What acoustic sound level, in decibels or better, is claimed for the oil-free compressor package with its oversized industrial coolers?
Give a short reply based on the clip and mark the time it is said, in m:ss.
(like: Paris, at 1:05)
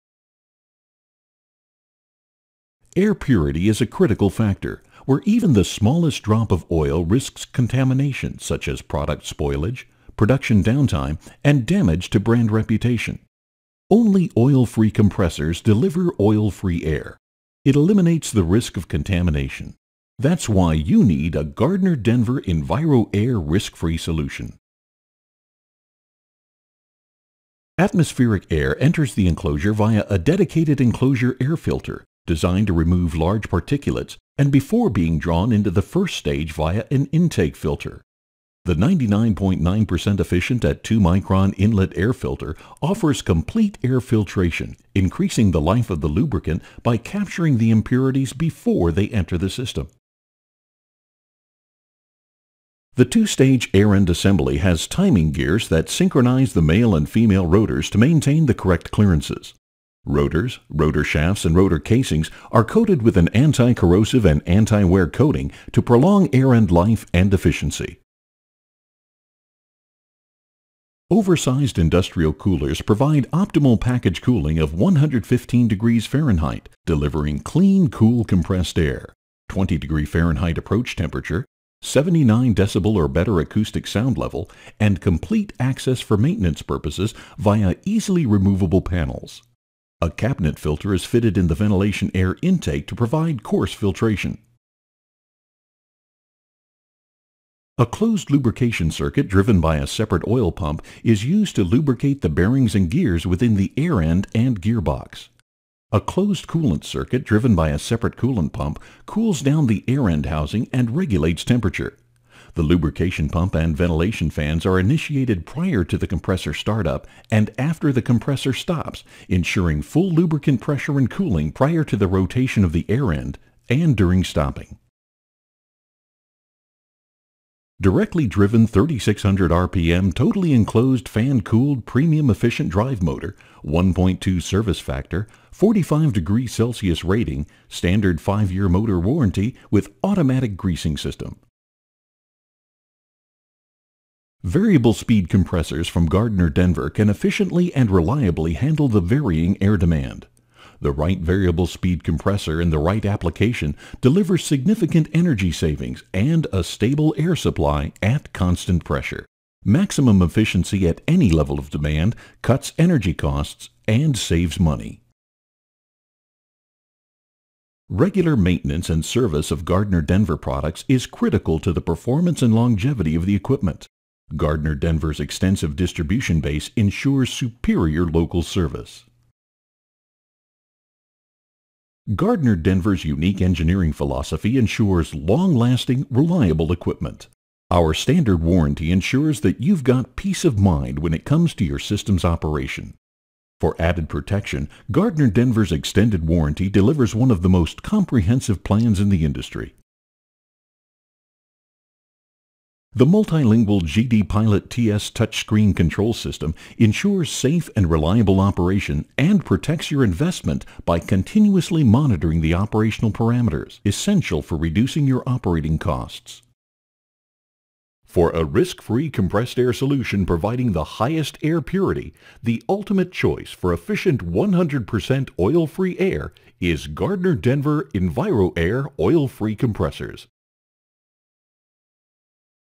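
79 decibel, at 1:21.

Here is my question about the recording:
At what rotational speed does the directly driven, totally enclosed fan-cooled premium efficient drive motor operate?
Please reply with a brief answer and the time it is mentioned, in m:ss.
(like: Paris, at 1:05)
3600 RPM, at 2:08.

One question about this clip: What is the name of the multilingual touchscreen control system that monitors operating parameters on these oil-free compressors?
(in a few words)
GD Pilot TS.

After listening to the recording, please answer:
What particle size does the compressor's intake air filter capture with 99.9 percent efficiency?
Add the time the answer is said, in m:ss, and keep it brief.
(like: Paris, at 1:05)
2 micron, at 0:40.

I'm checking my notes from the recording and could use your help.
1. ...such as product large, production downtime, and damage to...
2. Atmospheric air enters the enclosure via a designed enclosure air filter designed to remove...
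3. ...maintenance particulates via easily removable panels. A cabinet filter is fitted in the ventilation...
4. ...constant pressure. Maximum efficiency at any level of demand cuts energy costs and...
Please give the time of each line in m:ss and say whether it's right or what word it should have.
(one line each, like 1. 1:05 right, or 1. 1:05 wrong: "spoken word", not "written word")
1. 0:08 wrong: "spoilage", not "large"
2. 0:27 wrong: "dedicated", not "designed"
3. 1:26 wrong: "purposes", not "particulates"
4. 2:38 right.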